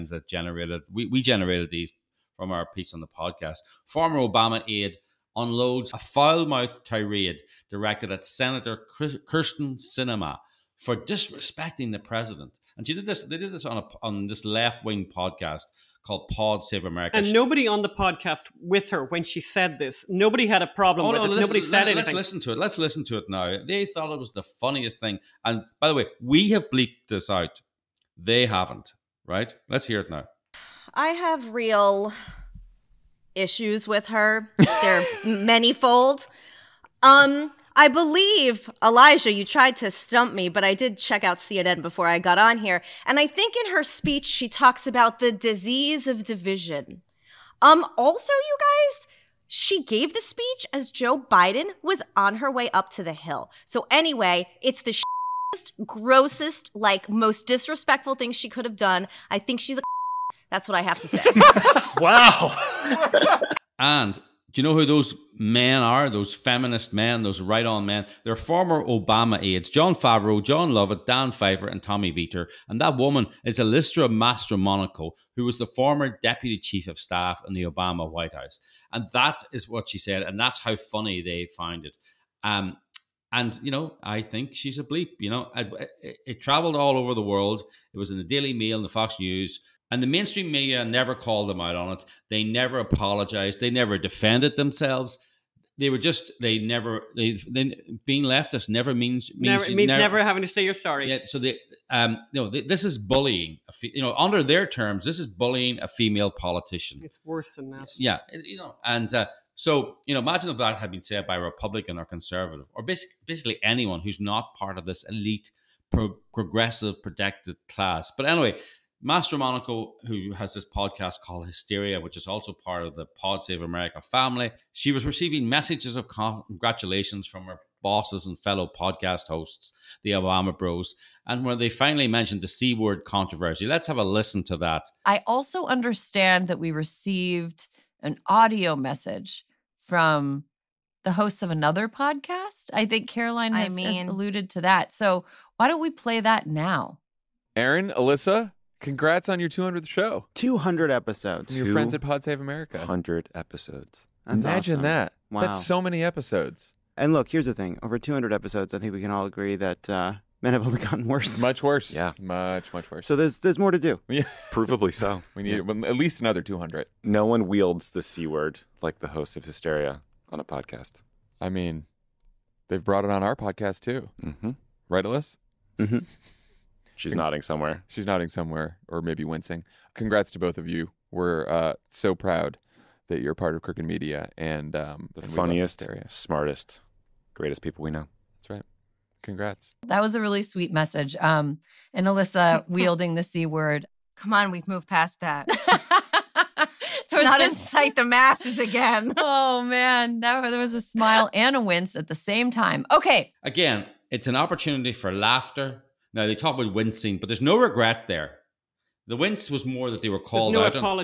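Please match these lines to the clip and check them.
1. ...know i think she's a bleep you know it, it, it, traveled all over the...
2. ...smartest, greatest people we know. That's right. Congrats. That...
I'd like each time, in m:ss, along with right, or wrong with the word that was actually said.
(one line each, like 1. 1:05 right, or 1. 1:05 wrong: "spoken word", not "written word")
1. 1:23 right
2. 3:06 right.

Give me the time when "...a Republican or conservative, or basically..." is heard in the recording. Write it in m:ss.
1:51.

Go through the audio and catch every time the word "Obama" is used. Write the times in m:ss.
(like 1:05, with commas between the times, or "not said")
0:04, 1:08, 1:17, 2:10.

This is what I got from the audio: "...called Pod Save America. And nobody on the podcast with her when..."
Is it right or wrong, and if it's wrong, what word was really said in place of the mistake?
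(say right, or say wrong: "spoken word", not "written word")
right.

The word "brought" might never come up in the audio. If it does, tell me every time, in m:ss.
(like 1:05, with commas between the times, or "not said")
2:52.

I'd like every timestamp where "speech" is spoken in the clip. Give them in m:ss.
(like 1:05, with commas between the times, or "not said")
0:43, 0:50.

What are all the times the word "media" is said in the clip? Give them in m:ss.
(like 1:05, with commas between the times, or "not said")
1:30, 3:03.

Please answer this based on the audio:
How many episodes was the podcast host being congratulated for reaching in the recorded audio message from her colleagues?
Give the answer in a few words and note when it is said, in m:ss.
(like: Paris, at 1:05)
200, at 2:29.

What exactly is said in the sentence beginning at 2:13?
Let's have a listen to that.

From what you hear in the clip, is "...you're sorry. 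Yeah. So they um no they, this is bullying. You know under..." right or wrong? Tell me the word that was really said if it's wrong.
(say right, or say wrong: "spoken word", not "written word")
right.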